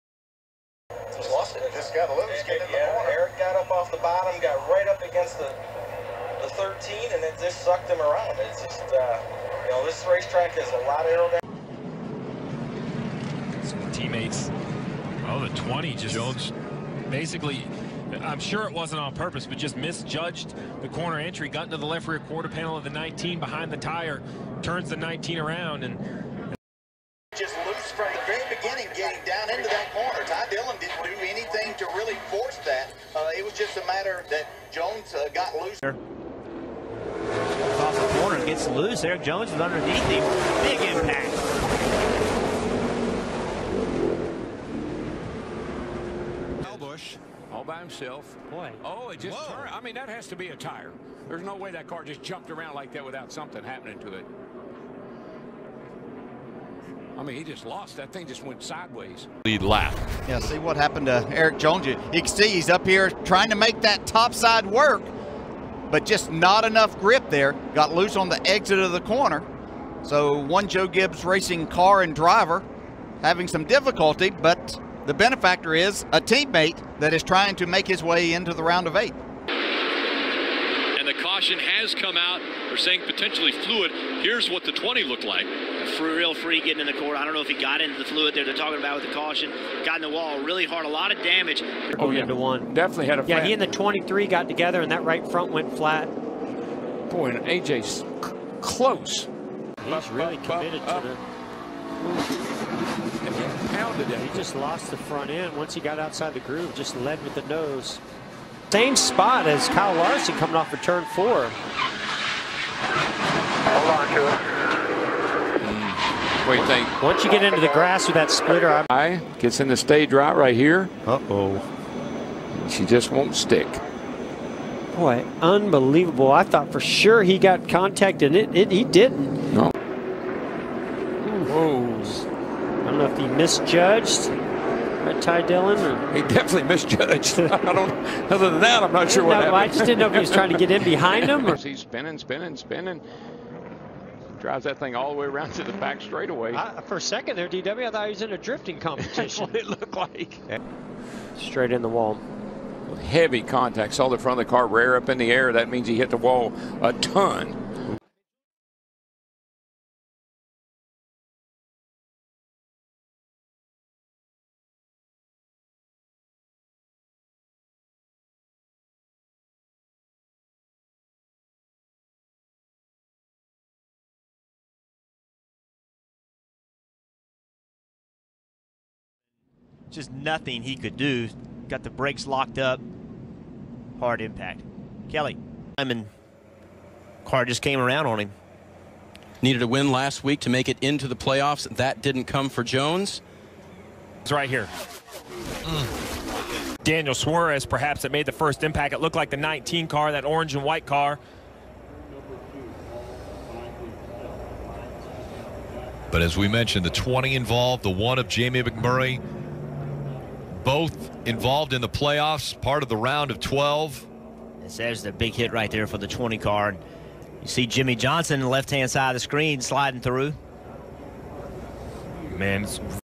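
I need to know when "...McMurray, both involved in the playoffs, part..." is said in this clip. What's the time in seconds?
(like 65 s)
208 s.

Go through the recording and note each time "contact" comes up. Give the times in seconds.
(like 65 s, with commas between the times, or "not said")
127 s, 153 s.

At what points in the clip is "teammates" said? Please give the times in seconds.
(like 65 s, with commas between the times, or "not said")
13 s, 76 s.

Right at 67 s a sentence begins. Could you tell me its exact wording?
Got loose on the exit of the corner.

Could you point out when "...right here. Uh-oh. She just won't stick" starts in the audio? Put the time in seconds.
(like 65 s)
120 s.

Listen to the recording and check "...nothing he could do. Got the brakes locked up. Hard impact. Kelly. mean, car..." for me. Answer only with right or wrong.
right.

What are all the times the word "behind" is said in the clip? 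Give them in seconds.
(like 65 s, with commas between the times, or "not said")
23 s, 140 s.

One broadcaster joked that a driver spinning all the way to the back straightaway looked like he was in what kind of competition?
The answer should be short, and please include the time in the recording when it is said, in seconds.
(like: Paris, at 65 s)
drifting competition, at 148 s.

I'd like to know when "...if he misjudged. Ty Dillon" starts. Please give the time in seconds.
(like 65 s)
133 s.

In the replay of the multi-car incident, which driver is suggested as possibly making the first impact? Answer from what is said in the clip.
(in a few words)
Daniel Suarez.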